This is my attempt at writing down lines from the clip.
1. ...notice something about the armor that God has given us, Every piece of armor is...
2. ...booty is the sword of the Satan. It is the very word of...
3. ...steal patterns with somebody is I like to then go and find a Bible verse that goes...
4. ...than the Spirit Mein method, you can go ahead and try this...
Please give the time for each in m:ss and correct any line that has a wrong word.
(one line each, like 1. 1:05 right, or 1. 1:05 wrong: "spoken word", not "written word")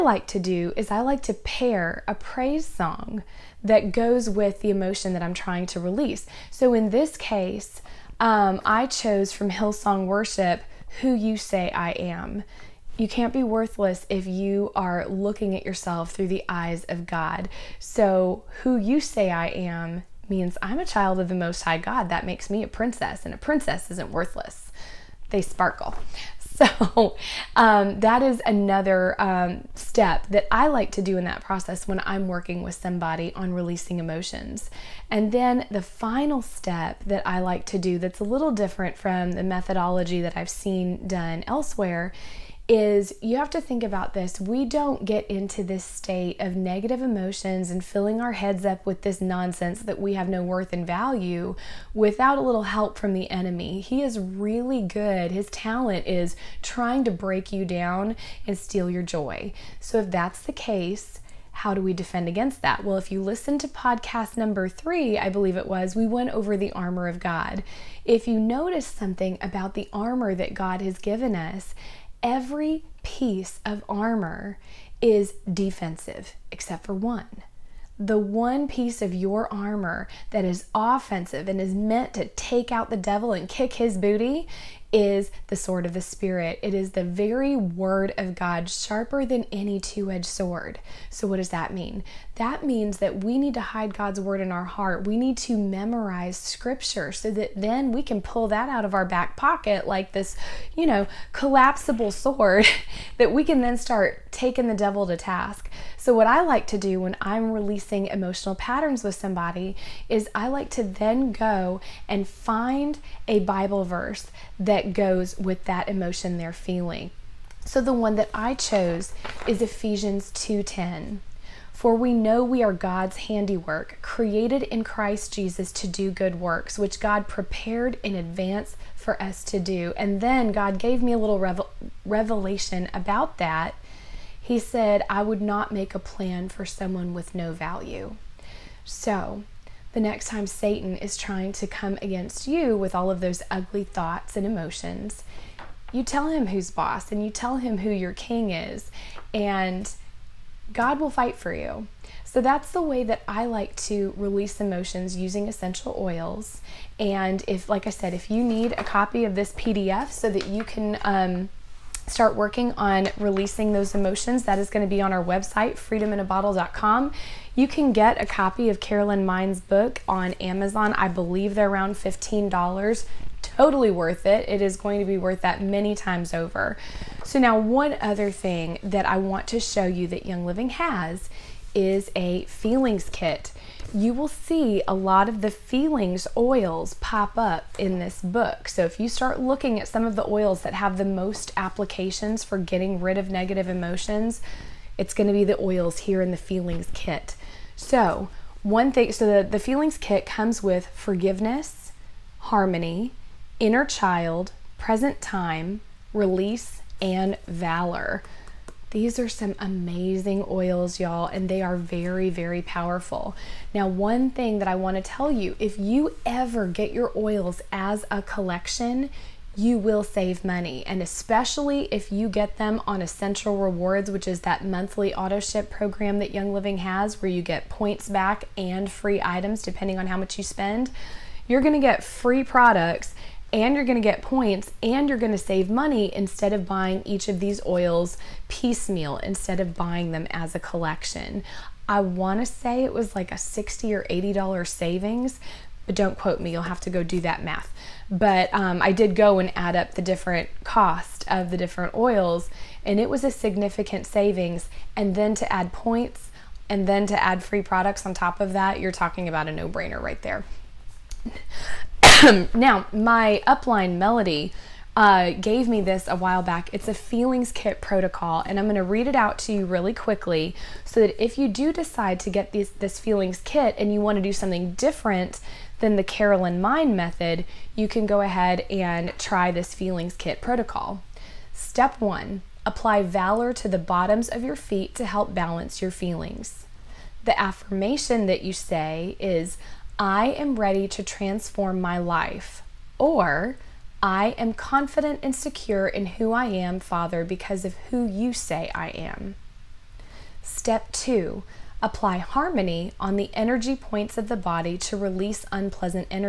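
1. 1:08 right
2. 1:23 wrong: "Spirit", not "Satan"
3. 1:48 wrong: "emotional", not "steal"
4. 4:35 wrong: "Carolyn", not "Spirit".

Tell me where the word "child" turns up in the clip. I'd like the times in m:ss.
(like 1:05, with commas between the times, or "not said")
0:20, 3:23.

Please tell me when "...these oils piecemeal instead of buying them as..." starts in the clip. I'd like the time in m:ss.
3:57.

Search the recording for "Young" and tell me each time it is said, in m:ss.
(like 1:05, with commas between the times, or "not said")
3:00, 3:46.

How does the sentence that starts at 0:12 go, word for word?
You can't be worthless if you are looking at yourself through the eyes of God.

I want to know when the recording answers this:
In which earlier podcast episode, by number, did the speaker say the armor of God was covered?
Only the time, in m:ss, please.
1:04.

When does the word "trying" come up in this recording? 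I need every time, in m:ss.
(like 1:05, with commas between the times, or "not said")
0:05, 0:56, 2:21.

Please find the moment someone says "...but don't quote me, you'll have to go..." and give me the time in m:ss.
4:05.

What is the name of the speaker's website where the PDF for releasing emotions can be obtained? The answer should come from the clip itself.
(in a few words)
freedominabottle.com.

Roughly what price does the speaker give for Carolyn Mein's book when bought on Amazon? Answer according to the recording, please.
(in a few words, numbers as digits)
$15.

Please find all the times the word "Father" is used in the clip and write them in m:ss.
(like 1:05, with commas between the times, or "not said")
4:56.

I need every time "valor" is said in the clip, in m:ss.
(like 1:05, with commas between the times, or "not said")
3:27, 4:43.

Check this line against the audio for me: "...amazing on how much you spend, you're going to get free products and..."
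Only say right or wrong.
wrong.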